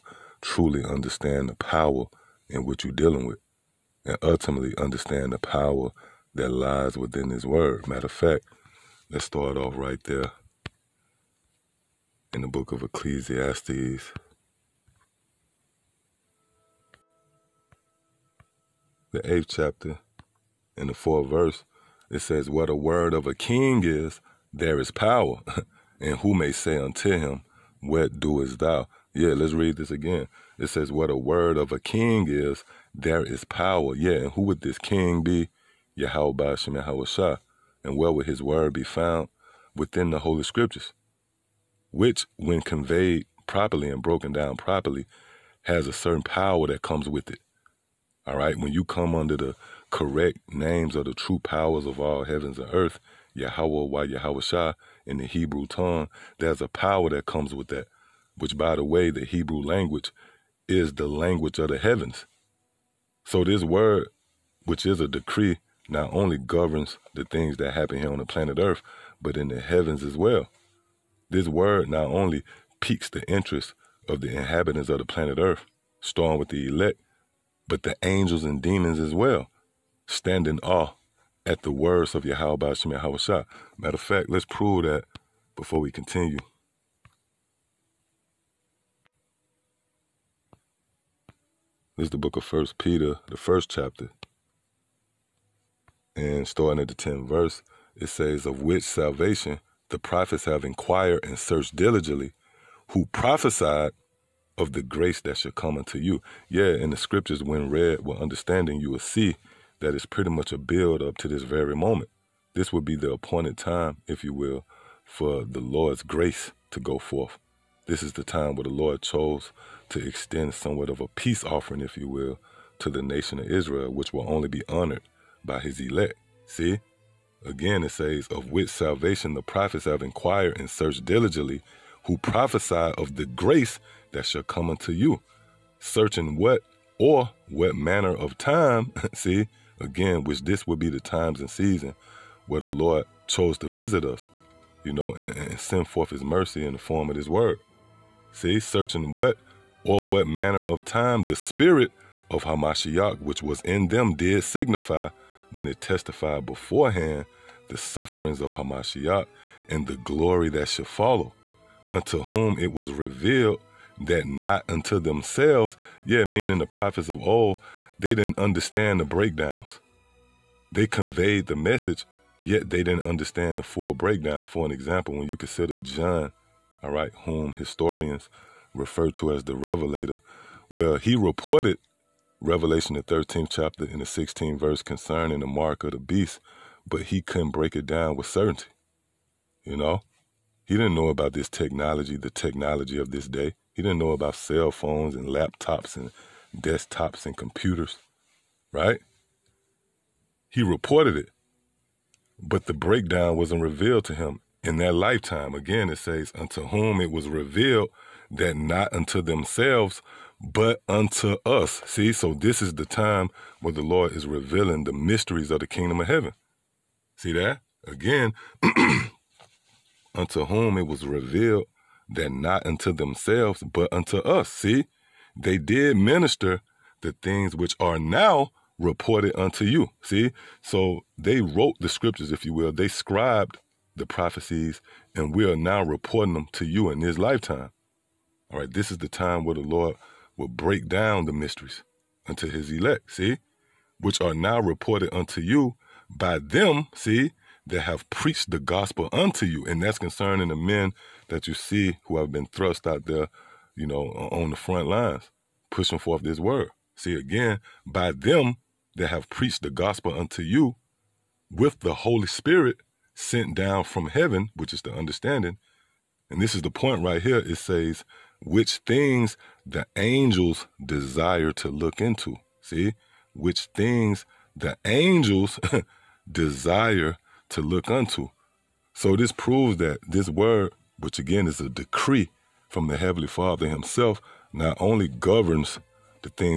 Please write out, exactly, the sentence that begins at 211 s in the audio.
See, so this is the time where the Lord is revealing the mysteries of the kingdom of heaven.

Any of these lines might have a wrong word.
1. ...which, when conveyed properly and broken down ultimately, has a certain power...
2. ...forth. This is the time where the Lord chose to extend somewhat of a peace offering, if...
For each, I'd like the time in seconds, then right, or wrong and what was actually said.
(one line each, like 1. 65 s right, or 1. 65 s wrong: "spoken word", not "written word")
1. 41 s wrong: "properly", not "ultimately"
2. 116 s right.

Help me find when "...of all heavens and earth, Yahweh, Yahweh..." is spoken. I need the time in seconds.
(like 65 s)
51 s.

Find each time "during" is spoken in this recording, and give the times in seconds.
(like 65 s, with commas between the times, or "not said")
not said.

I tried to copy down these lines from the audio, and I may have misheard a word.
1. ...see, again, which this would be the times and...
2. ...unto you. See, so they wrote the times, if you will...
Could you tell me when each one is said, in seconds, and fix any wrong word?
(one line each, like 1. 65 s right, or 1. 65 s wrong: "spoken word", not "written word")
1. 139 s right
2. 229 s wrong: "scriptures", not "times".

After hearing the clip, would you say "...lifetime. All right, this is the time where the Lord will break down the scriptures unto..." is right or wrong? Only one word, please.
wrong.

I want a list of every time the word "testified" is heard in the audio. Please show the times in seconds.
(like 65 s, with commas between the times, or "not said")
155 s.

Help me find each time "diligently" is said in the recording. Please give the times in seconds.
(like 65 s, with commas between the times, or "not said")
101 s, 131 s.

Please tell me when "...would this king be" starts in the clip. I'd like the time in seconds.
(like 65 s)
34 s.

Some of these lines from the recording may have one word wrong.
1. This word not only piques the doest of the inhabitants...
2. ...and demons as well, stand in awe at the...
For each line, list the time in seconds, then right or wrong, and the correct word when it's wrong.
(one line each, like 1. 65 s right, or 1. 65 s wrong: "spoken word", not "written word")
1. 71 s wrong: "interest", not "doest"
2. 78 s right.